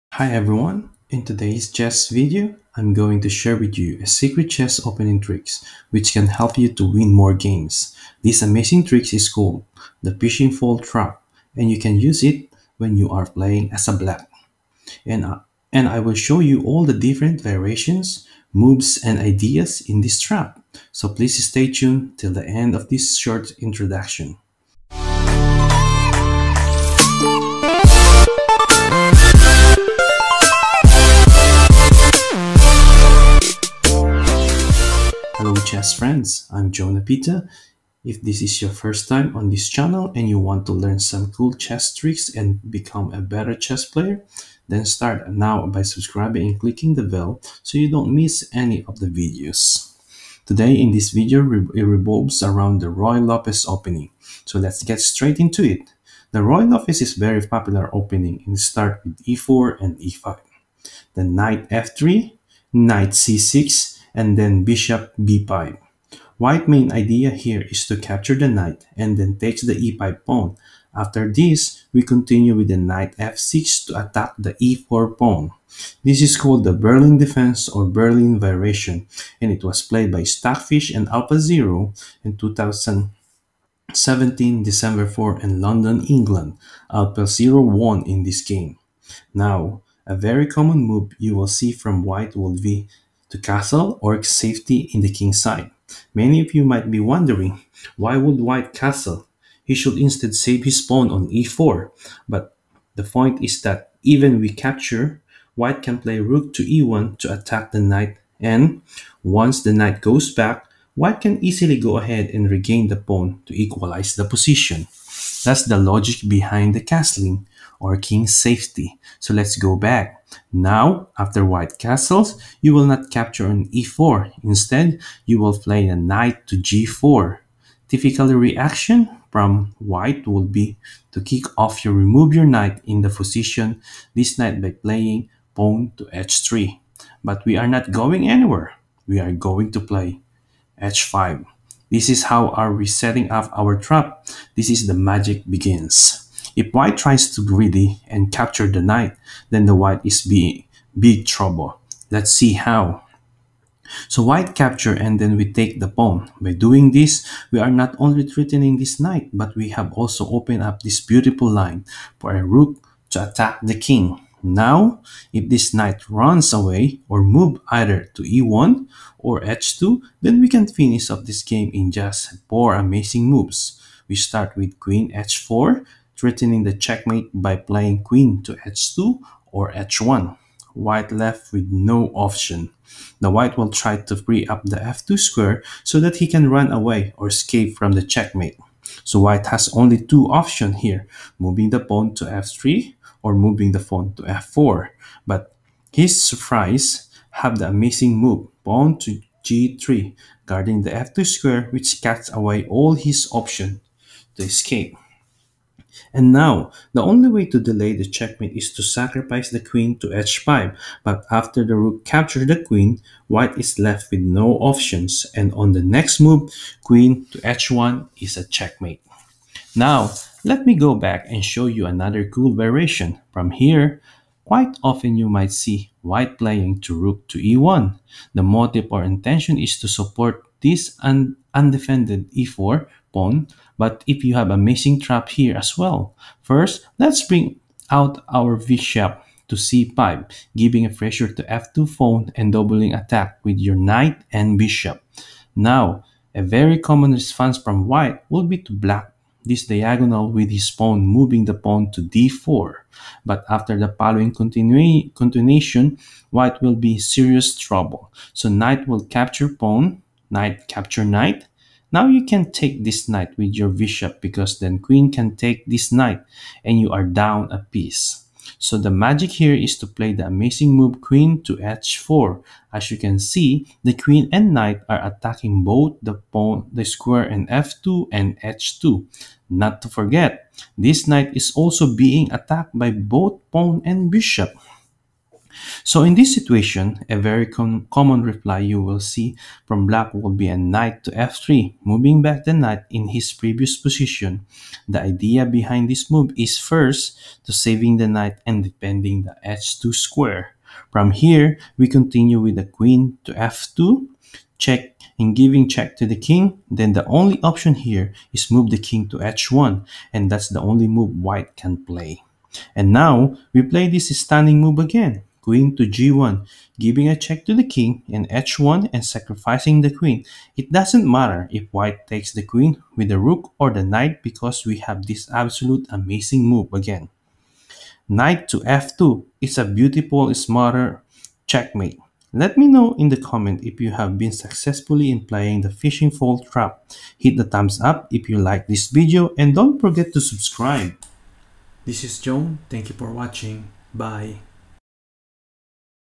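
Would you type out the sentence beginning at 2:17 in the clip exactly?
But we are not going anywhere.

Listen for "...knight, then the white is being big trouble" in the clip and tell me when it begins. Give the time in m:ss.
2:28.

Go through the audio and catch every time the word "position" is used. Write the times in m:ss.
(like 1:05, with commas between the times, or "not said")
1:54, 2:13, 4:53.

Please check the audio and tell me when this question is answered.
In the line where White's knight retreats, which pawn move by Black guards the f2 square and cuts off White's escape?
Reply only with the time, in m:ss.
3:18.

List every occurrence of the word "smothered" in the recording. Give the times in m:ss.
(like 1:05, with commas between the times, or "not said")
5:30.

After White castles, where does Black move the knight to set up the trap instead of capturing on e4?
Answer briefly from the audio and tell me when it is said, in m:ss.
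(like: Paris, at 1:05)
g4, at 2:06.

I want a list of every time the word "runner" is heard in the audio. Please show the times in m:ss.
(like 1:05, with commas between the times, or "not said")
not said.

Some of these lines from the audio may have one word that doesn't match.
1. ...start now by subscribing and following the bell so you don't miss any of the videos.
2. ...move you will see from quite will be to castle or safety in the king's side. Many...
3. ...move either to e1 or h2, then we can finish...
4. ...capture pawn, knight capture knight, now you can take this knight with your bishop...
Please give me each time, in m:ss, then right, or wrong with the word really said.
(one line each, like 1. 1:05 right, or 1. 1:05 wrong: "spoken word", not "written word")
1. 0:44 wrong: "clicking", not "following"
2. 1:30 wrong: "white", not "quite"
3. 2:47 right
4. 4:19 right.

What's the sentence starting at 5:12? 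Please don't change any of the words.
And now, we play this stunning move again.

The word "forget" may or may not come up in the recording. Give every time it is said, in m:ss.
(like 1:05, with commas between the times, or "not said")
4:39, 5:39.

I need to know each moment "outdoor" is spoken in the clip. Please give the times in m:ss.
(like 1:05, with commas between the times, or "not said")
not said.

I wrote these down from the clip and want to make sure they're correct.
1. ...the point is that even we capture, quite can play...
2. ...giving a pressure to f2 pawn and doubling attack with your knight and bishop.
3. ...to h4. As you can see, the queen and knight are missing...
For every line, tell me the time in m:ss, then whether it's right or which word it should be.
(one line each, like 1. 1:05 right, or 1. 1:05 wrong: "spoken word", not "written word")
1. 1:42 wrong: "white", not "quite"
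2. 4:00 right
3. 4:31 wrong: "attacking", not "missing".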